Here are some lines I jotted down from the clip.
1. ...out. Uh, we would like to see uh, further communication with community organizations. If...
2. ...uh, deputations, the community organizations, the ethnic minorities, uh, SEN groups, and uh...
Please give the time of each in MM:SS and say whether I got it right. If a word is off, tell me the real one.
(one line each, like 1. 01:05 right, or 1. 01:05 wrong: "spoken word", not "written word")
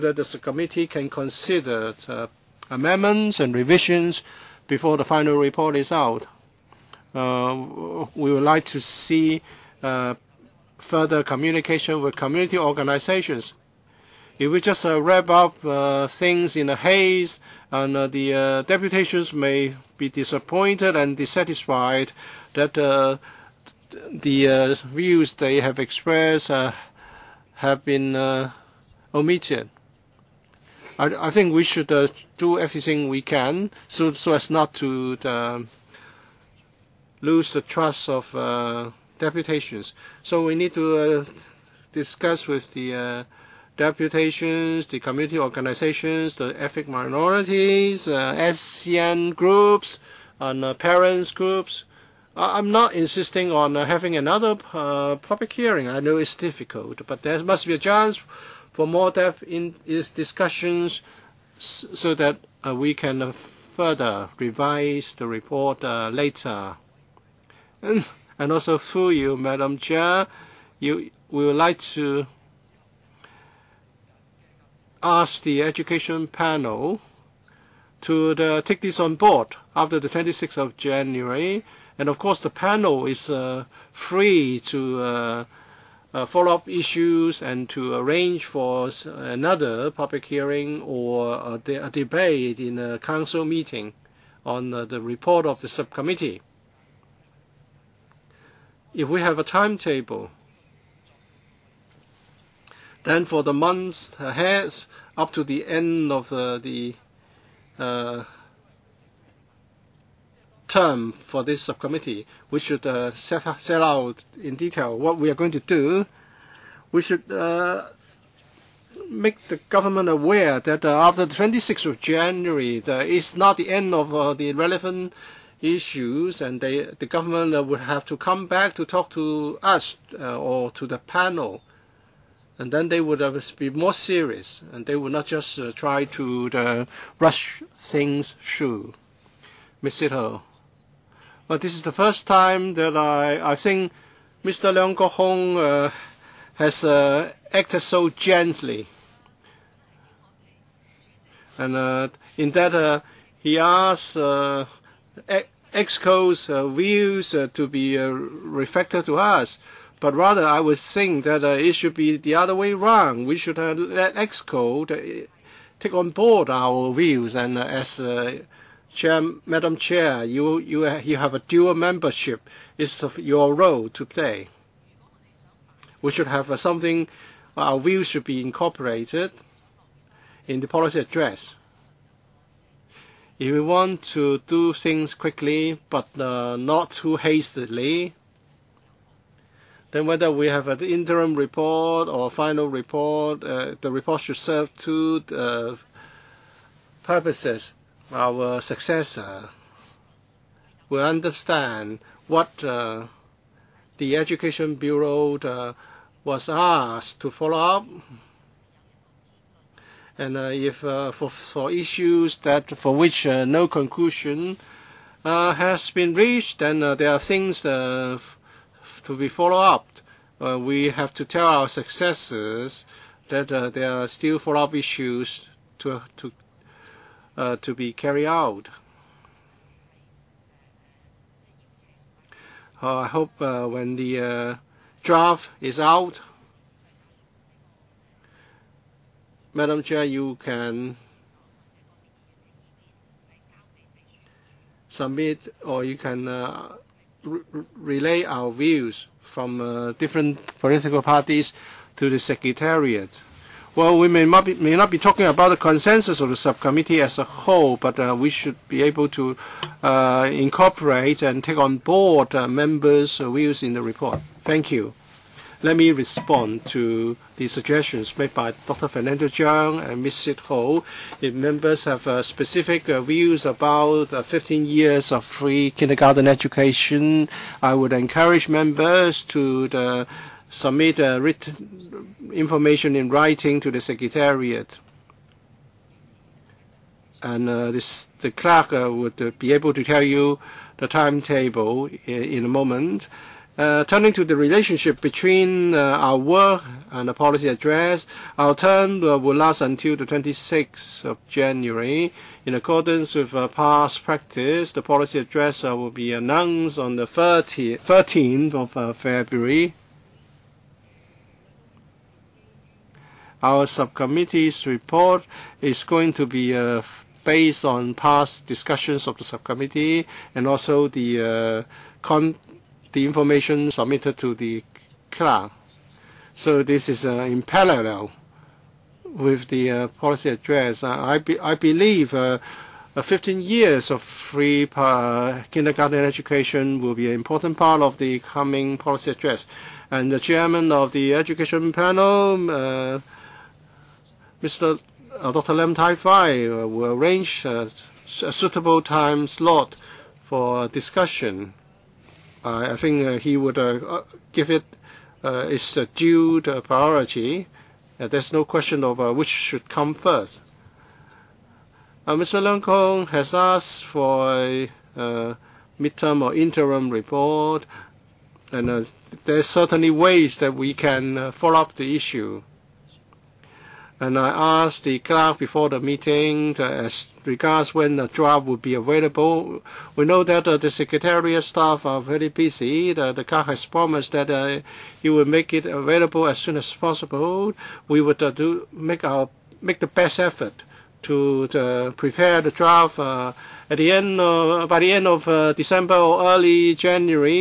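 1. 00:05 right
2. 00:42 right.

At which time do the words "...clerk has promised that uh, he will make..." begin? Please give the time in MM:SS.
06:23.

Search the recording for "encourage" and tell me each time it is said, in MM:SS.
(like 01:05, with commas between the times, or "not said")
04:37.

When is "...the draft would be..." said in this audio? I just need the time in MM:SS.
06:17.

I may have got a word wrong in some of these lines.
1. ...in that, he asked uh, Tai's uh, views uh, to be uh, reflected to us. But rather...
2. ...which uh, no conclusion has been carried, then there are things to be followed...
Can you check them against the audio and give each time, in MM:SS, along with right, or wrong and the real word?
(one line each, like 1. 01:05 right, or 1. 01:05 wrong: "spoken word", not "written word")
1. 02:32 wrong: "Exco", not "Tai"
2. 03:32 wrong: "reached", not "carried".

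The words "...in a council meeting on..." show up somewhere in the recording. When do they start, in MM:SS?
01:32.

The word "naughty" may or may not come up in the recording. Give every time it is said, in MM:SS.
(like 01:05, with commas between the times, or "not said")
not said.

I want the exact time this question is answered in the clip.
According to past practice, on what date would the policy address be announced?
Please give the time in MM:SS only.
05:07.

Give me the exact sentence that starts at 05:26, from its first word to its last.
So this is uh, in parallel with the uh, policy address.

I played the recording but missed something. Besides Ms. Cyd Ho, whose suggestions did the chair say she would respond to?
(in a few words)
Dr. Fernando Cheung.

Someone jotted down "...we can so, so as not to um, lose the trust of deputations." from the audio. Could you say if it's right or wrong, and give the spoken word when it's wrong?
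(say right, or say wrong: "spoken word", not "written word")
right.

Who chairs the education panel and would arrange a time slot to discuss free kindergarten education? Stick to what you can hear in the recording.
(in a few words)
Dr. Lam Tai Fai.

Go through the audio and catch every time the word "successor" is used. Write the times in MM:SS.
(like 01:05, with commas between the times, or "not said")
03:18, 03:41.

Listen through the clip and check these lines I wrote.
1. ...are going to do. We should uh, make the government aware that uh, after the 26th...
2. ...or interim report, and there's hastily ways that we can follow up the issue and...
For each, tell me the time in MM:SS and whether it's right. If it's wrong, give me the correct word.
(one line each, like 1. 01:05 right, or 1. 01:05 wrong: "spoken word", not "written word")
1. 01:55 right
2. 06:06 wrong: "certainly", not "hastily".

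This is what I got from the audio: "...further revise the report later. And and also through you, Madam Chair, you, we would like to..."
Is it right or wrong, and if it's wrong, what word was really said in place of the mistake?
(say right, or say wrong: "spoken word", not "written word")
right.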